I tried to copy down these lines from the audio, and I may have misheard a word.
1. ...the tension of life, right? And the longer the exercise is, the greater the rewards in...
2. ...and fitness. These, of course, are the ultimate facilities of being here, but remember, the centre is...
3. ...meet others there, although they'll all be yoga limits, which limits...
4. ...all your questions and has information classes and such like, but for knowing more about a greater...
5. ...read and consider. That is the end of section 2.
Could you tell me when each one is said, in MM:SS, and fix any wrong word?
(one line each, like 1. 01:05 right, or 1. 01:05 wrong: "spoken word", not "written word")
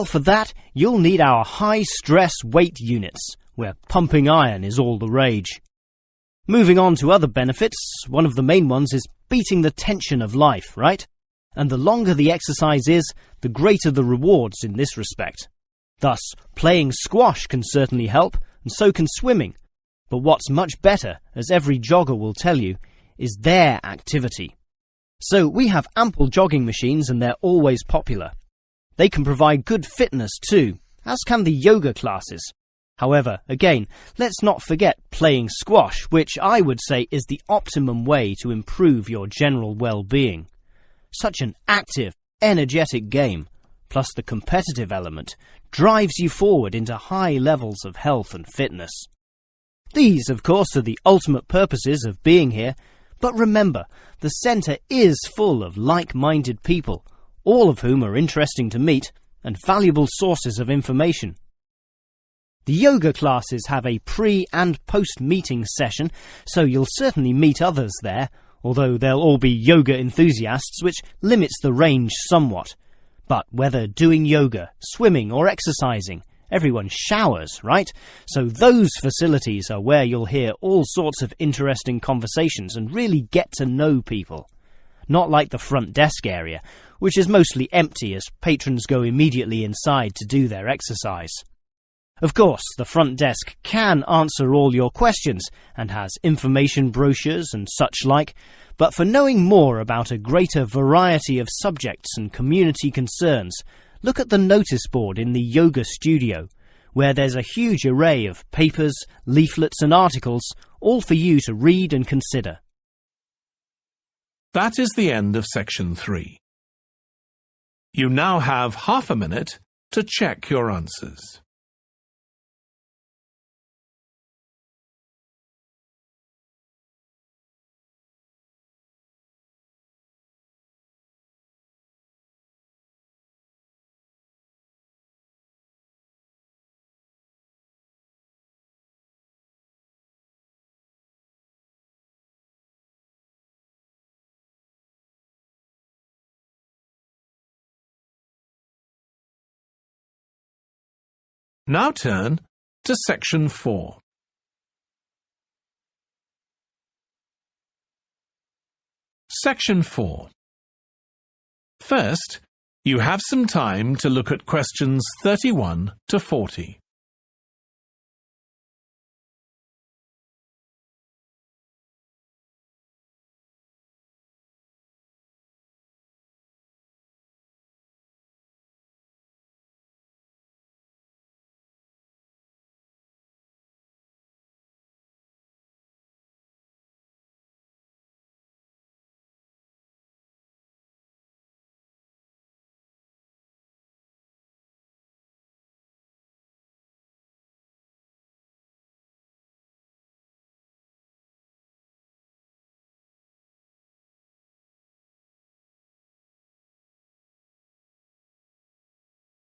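1. 00:09 right
2. 00:48 wrong: "purposes", not "facilities"
3. 01:07 wrong: "enthusiasts", not "limits"
4. 01:34 wrong: "brochures", not "classes"
5. 01:51 wrong: "3", not "2".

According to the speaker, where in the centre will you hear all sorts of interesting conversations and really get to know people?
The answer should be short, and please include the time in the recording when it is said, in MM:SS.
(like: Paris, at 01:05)
showers, at 01:16.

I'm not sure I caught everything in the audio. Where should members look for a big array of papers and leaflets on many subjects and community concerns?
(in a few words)
notice board in the yoga studio.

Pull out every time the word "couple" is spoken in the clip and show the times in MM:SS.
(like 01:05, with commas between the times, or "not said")
not said.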